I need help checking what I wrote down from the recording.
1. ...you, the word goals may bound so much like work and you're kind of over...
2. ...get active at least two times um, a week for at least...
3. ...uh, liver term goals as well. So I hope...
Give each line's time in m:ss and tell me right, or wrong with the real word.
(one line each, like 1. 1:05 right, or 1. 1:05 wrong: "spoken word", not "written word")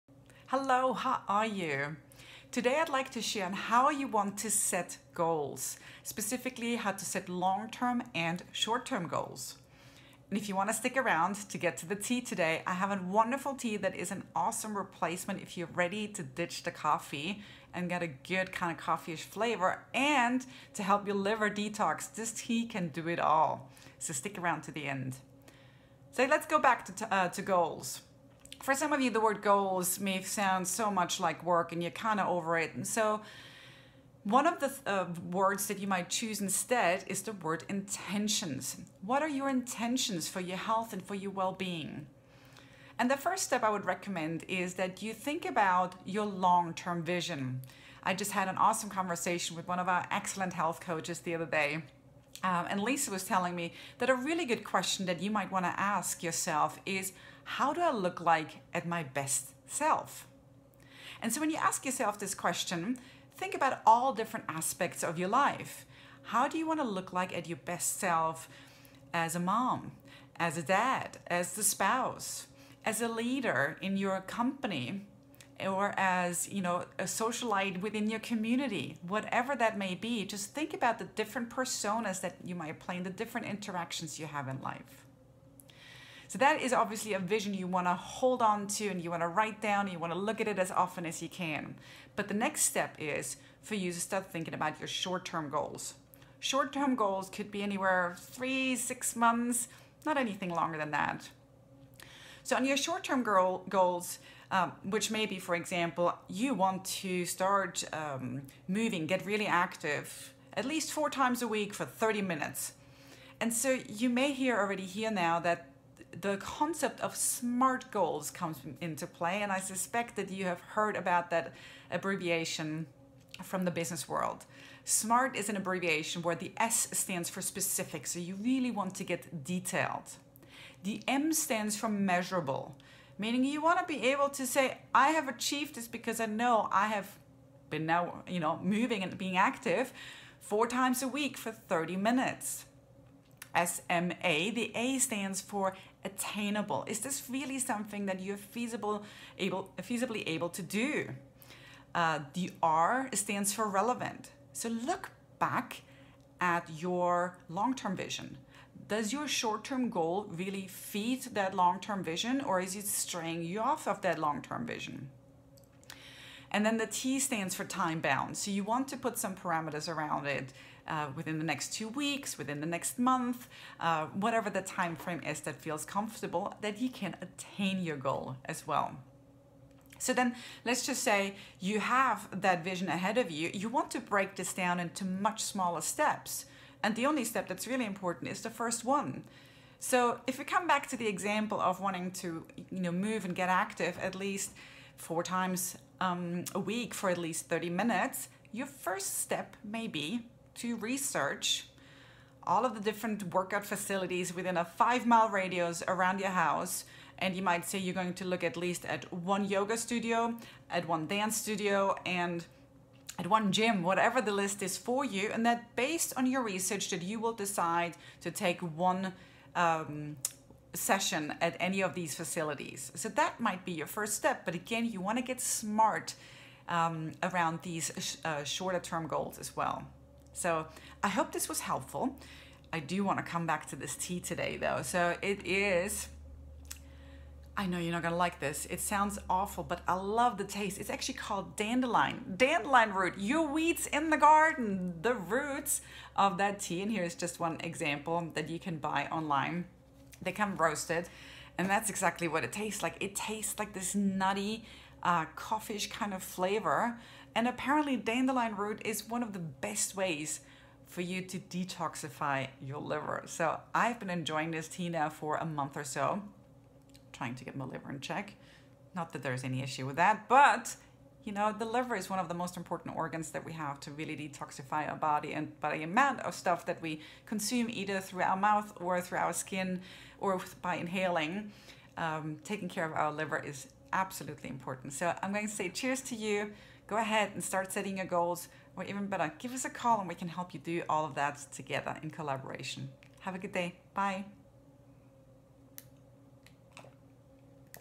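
1. 0:29 wrong: "sound", not "bound"
2. 3:13 wrong: "four", not "two"
3. 3:48 wrong: "shorter", not "liver".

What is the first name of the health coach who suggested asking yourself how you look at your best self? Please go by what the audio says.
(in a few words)
Lisa.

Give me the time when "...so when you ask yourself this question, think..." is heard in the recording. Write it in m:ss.
1:01.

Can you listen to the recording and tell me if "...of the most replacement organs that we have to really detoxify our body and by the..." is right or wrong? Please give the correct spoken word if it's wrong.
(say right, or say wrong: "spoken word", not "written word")
wrong: "important", not "replacement".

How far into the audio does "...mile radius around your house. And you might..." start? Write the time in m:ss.
3:25.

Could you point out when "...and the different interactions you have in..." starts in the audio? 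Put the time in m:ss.
1:22.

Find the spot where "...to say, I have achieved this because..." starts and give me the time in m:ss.
2:14.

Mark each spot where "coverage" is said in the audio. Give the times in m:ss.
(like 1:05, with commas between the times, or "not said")
not said.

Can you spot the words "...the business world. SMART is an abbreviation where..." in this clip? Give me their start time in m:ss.
2:03.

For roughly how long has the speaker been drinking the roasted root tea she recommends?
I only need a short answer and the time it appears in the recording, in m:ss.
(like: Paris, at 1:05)
a month, at 4:25.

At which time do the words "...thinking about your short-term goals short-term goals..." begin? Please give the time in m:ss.
1:34.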